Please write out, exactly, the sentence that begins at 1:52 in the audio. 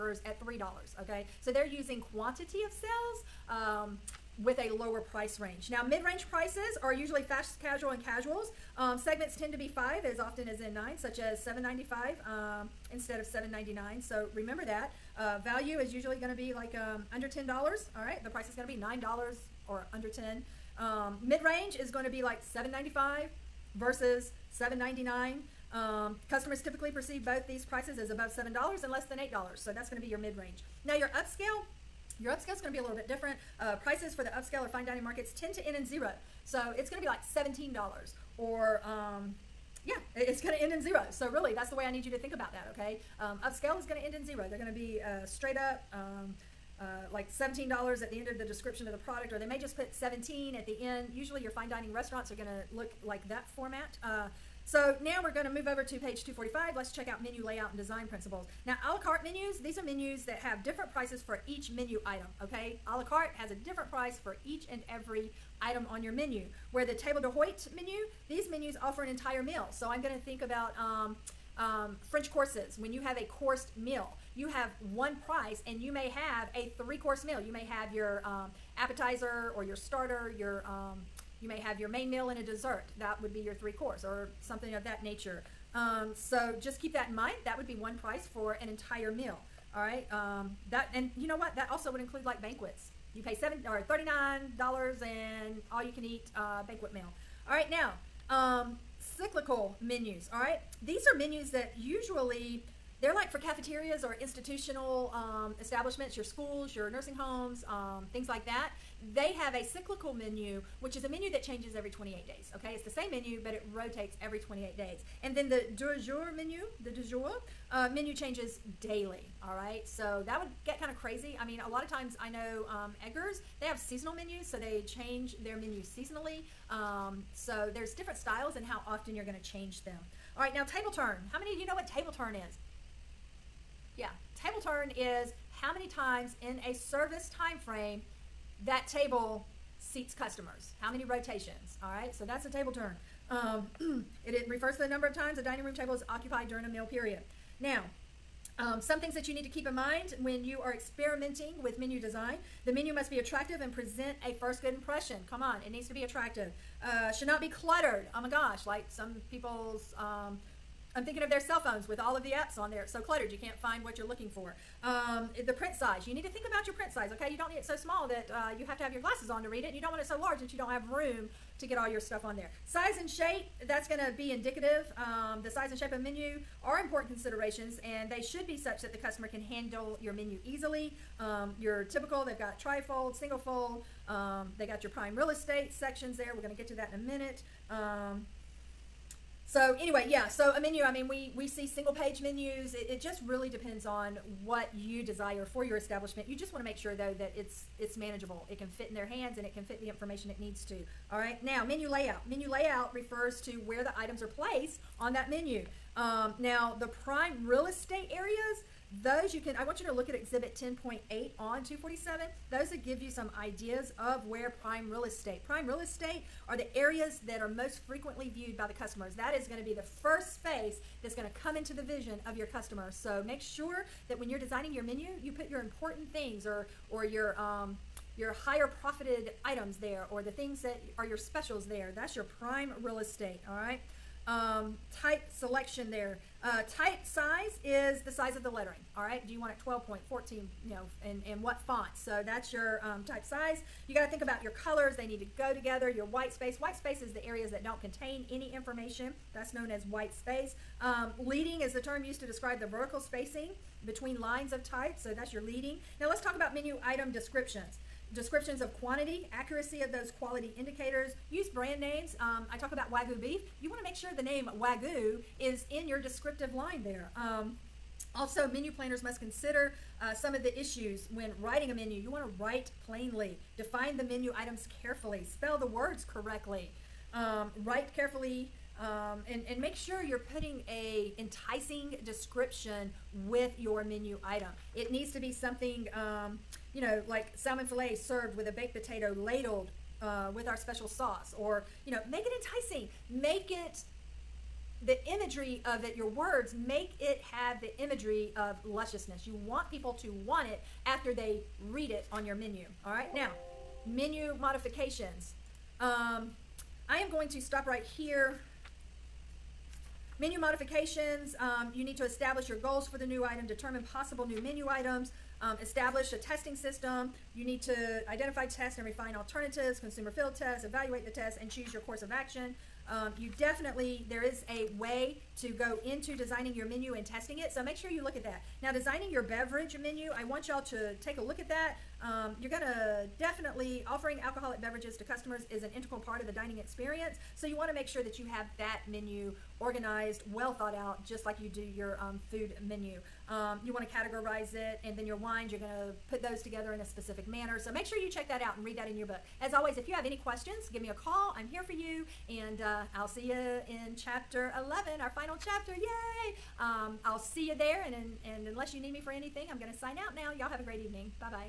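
Okay, it's the same menu, but it rotates every 28 days.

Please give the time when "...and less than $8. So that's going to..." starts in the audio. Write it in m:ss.
0:28.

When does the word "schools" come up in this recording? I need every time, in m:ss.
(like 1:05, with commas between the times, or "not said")
1:46.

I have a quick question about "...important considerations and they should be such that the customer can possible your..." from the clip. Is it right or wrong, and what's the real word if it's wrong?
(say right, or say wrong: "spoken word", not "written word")
wrong: "handle", not "possible".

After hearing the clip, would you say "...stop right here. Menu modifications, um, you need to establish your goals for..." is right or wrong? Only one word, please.
right.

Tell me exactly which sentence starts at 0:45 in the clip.
Um, uh, like $17 at the end of the description of the product, or they may just put 17 at the end.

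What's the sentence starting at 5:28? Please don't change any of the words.
Now designing your beverage menu, I want y'all to take a look at that.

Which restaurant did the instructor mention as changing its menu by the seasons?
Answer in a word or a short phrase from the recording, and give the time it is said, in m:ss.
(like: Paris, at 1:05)
Edgar's, at 2:03.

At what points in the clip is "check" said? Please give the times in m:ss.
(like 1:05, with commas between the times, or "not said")
0:56, 5:48.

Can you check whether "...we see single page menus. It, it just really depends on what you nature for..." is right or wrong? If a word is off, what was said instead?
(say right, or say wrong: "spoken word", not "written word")
wrong: "desire", not "nature".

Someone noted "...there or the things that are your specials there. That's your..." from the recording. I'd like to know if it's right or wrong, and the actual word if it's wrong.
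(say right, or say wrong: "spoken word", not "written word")
right.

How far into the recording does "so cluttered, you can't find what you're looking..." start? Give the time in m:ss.
2:42.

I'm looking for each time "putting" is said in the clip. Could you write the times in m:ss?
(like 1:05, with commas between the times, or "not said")
4:40.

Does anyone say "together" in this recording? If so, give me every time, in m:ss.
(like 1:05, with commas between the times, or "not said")
4:05, 5:46.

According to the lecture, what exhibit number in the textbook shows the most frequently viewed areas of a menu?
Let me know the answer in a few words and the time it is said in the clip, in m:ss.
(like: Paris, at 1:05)
10.8, at 3:30.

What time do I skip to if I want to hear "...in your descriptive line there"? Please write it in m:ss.
4:25.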